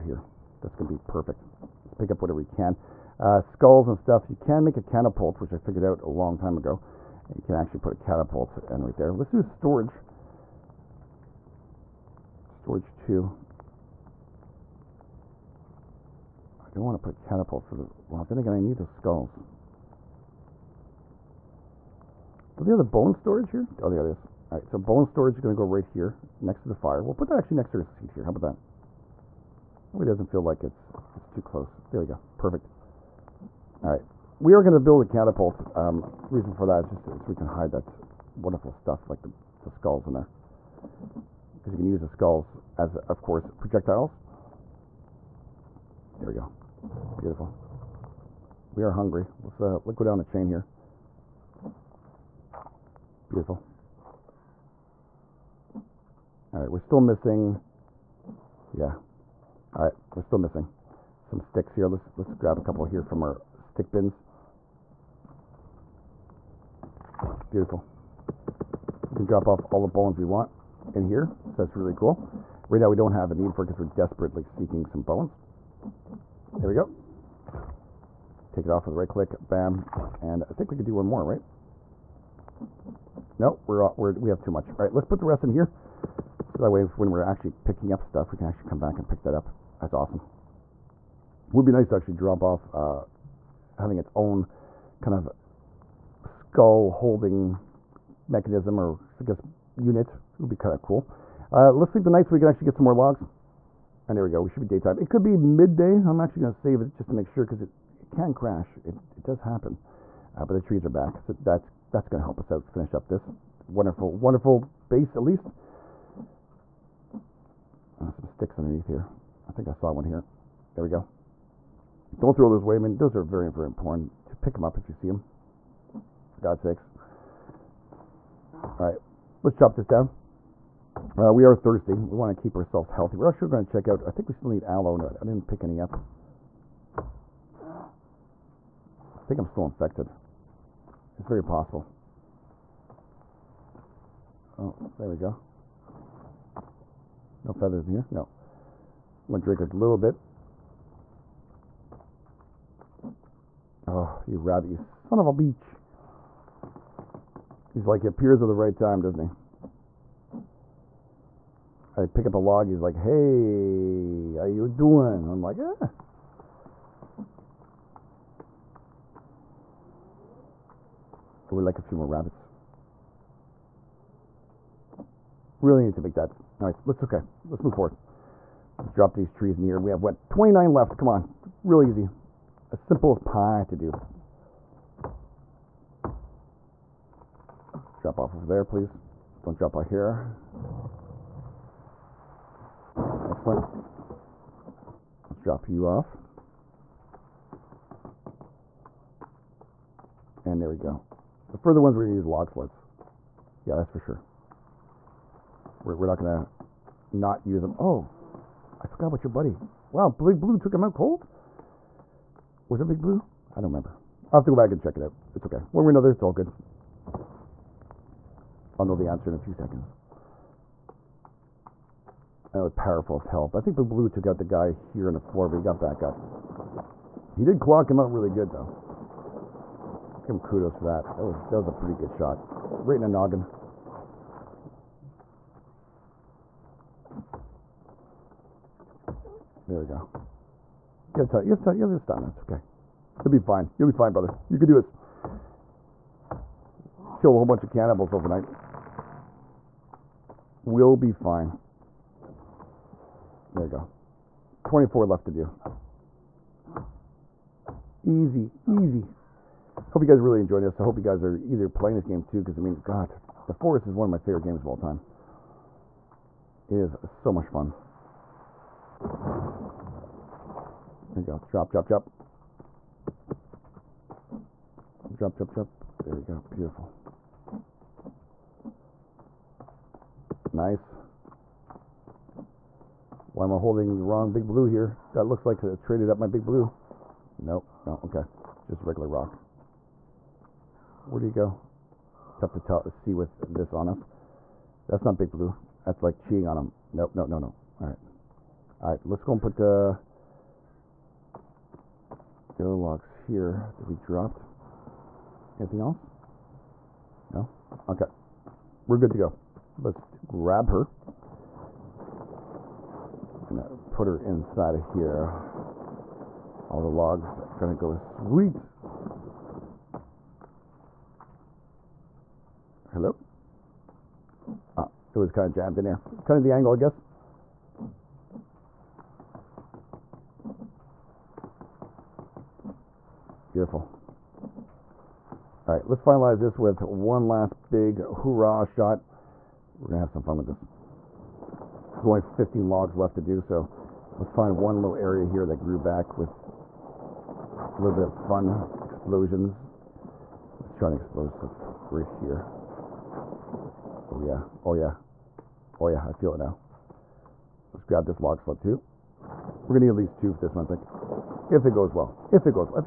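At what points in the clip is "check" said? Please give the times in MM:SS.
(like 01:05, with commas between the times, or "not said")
02:13, 03:34.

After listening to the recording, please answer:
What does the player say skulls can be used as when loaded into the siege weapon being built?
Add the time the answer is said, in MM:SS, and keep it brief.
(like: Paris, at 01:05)
projectiles, at 00:43.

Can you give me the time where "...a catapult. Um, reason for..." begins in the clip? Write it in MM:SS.
00:35.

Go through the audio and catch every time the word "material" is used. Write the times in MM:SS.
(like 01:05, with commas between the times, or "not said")
not said.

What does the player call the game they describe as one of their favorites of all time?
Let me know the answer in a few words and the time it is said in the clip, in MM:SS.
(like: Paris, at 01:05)
The Forest, at 04:23.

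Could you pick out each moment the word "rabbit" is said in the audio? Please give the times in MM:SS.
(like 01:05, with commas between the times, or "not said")
02:34, 02:52.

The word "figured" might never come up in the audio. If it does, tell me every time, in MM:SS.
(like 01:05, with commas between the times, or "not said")
00:05.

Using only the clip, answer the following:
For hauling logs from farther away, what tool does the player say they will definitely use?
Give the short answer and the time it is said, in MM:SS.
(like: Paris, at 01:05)
log sleds, at 03:22.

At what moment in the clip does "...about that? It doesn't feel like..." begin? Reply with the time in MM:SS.
00:28.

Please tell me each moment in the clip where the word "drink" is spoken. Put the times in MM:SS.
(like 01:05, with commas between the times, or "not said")
02:29.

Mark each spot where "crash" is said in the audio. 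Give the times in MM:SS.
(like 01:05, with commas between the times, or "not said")
01:48.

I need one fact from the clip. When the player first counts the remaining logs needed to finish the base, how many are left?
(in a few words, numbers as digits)
29.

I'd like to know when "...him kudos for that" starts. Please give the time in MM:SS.
03:50.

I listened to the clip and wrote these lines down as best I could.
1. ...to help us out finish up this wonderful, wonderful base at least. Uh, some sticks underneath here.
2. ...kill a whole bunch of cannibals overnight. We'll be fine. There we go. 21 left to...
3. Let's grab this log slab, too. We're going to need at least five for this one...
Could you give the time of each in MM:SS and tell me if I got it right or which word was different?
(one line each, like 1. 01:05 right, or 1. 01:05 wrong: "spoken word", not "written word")
1. 01:52 right
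2. 04:07 wrong: "24", not "21"
3. 05:57 wrong: "two", not "five".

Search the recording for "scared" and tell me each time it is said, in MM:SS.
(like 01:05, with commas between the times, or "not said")
not said.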